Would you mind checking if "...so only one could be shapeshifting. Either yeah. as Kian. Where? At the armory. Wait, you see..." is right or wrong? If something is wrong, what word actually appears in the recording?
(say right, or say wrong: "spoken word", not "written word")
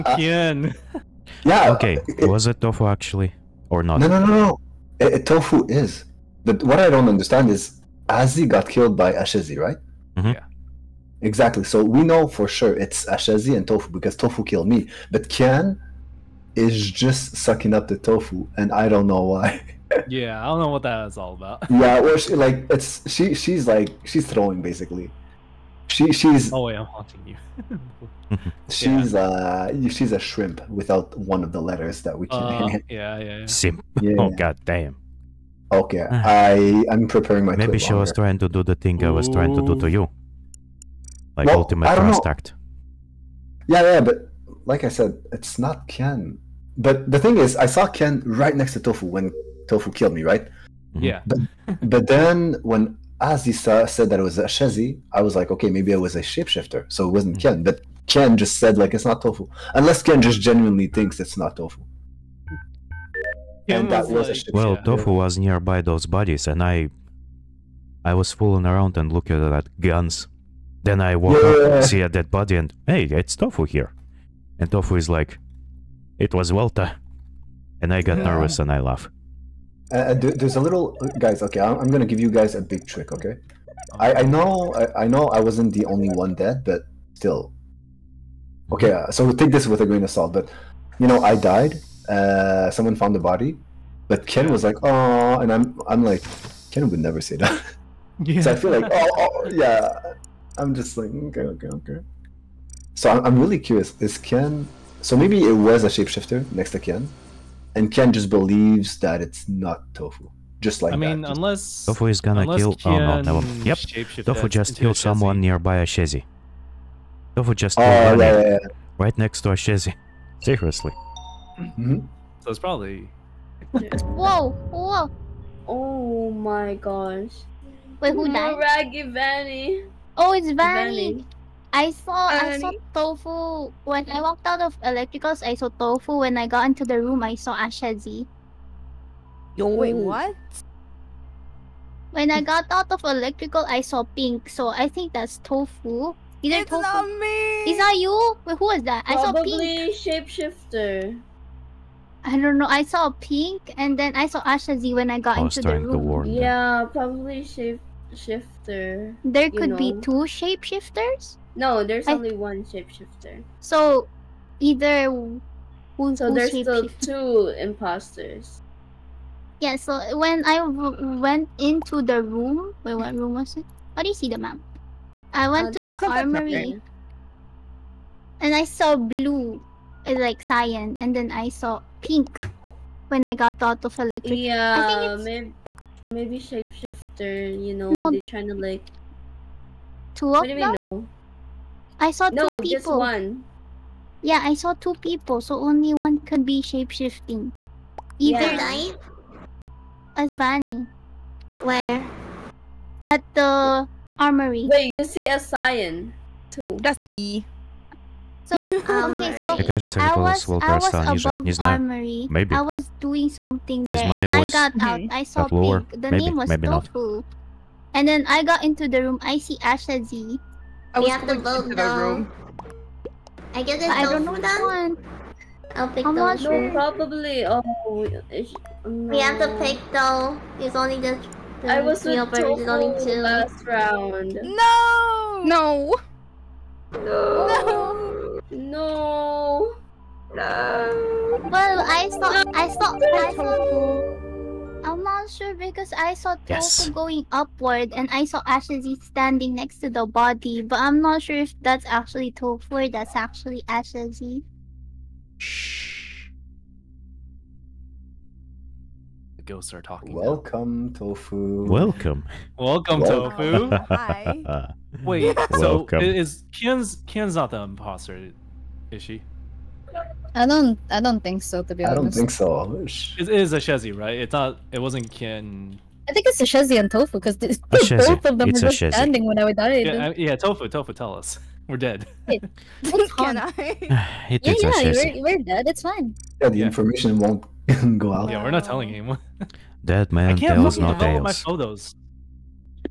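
wrong: "Vani", not "Kian".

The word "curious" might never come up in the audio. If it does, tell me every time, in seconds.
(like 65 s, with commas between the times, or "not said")
103 s.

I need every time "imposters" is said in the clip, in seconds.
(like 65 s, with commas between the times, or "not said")
167 s, 267 s.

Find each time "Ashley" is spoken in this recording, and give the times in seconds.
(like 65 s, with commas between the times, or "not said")
248 s, 253 s.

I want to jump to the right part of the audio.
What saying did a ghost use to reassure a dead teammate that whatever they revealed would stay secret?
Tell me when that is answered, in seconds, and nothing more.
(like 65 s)
289 s.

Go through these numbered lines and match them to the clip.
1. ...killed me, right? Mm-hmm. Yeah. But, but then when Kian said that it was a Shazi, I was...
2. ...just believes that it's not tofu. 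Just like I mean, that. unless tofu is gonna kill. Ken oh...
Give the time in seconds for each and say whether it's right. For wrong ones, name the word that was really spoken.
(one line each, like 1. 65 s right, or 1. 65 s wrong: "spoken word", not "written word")
1. 49 s wrong: "Aziza", not "Kian"
2. 108 s right.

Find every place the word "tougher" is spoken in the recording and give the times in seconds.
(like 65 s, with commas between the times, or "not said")
not said.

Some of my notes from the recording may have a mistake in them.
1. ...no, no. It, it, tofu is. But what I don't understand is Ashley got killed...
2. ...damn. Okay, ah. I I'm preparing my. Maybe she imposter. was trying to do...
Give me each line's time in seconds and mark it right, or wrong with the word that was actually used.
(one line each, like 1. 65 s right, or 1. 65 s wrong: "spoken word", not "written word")
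1. 4 s wrong: "Azzi", not "Ashley"
2. 34 s wrong: "longer", not "imposter".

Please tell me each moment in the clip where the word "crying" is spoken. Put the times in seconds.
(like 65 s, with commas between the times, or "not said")
not said.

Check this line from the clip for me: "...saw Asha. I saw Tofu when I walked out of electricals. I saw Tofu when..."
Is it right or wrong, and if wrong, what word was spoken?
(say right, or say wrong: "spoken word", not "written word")
wrong: "Vanny", not "Asha".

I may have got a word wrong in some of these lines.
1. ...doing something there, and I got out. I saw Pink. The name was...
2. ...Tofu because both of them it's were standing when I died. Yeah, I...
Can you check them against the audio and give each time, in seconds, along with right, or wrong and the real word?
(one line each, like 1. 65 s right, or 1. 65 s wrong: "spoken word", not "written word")
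1. 212 s right
2. 276 s right.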